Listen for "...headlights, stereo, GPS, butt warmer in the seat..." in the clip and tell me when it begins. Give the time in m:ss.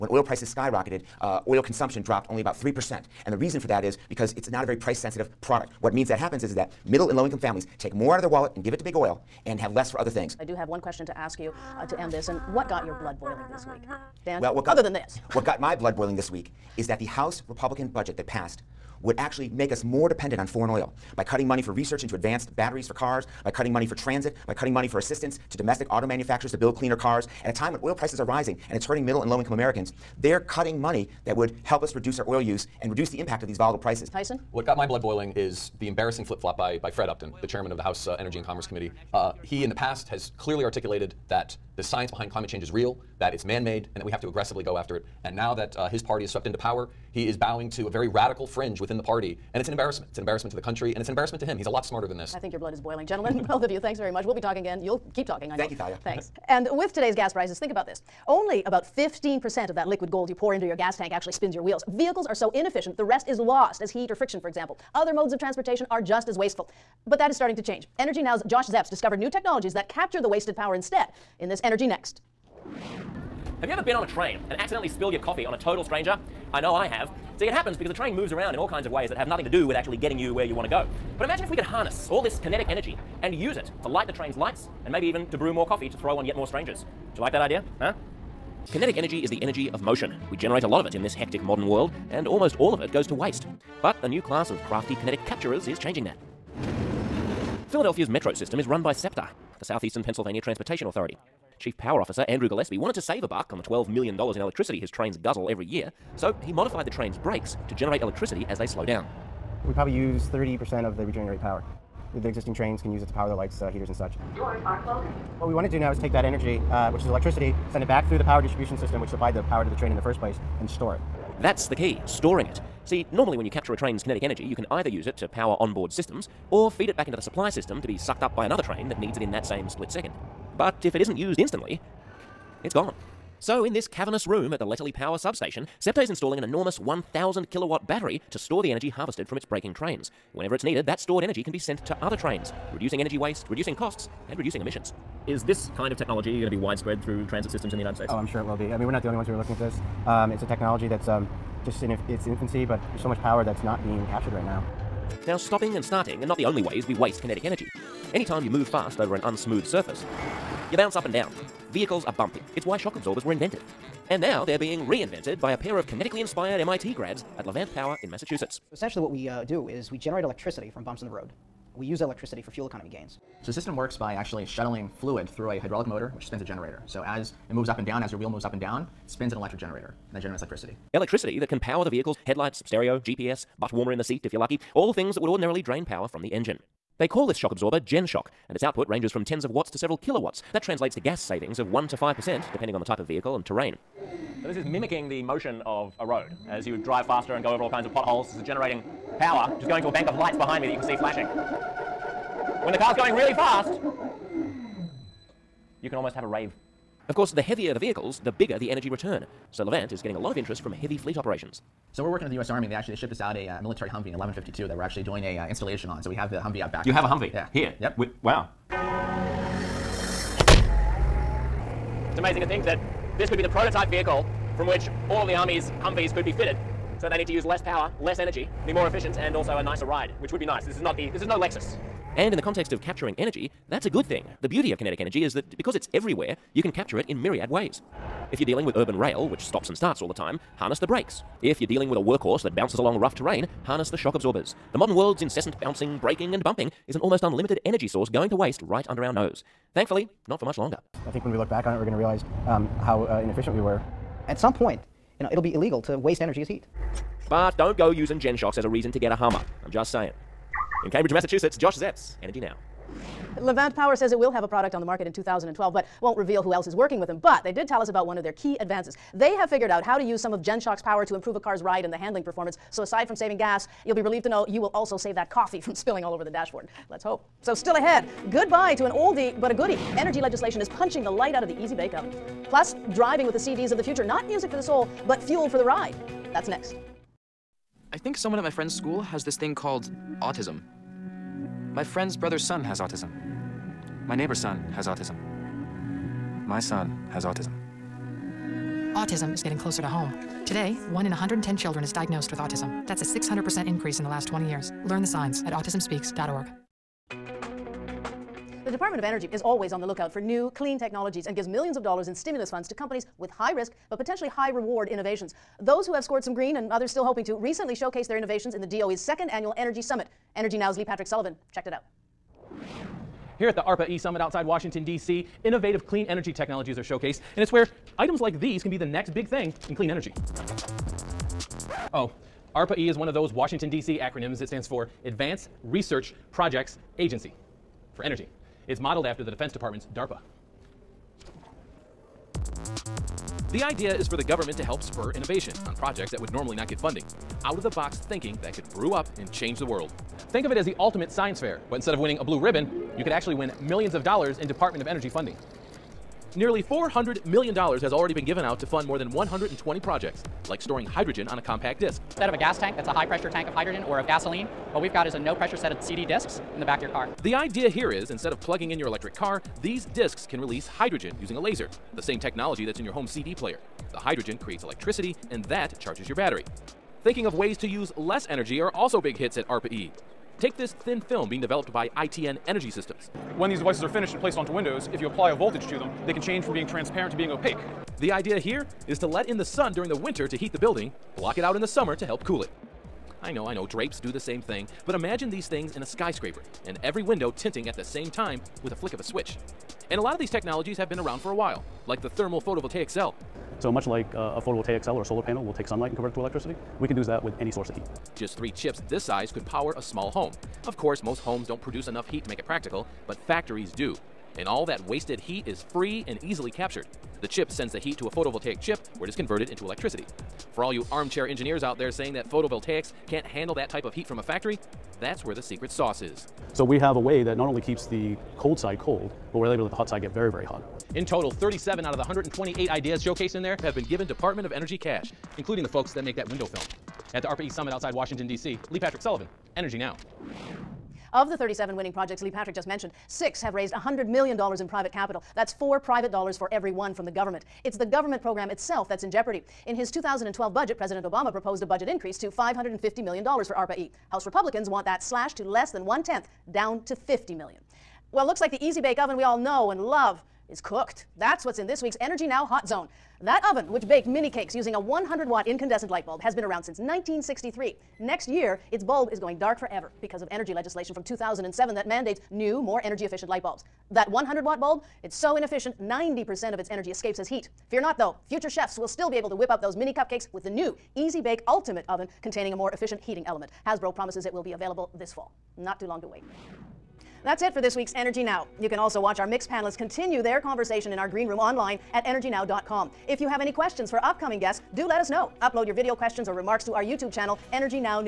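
3:02.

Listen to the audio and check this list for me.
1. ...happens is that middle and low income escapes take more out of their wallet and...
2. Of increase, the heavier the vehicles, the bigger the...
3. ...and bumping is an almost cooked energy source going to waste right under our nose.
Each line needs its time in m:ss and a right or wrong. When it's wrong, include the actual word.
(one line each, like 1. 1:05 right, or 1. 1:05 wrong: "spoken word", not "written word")
1. 0:06 wrong: "families", not "escapes"
2. 3:27 wrong: "course", not "increase"
3. 4:06 wrong: "unlimited", not "cooked".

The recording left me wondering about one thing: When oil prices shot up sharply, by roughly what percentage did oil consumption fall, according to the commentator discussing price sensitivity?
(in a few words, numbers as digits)
3%.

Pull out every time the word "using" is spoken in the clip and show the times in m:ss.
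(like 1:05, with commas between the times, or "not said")
4:17, 6:11, 7:44.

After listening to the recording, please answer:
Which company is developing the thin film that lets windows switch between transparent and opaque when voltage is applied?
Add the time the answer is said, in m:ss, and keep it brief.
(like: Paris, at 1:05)
ITN Energy Systems, at 6:21.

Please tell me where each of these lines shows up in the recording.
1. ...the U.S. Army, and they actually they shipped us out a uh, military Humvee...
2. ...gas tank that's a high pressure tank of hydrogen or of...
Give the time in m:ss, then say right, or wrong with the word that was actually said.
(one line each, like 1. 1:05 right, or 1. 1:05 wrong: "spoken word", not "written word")
1. 3:32 right
2. 6:02 right.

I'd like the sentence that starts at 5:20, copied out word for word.
Energy Now's Lee Patrick Sullivan checked it out.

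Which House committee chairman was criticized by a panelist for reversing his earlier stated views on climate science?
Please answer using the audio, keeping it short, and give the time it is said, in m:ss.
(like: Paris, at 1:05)
Fred Upton, at 0:36.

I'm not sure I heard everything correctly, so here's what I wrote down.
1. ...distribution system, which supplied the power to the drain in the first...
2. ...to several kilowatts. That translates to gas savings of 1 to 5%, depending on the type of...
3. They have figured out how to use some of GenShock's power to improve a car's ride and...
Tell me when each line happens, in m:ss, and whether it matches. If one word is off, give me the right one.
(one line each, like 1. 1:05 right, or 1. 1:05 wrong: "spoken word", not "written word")
1. 1:58 wrong: "train", not "drain"
2. 3:09 right
3. 4:29 right.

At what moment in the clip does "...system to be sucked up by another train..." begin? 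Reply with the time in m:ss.
2:07.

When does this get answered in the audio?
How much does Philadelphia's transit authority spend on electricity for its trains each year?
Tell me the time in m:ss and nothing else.
1:43.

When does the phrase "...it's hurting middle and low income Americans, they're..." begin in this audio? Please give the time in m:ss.
0:28.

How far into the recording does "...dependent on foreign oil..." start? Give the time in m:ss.
0:20.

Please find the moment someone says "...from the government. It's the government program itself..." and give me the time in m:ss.
7:26.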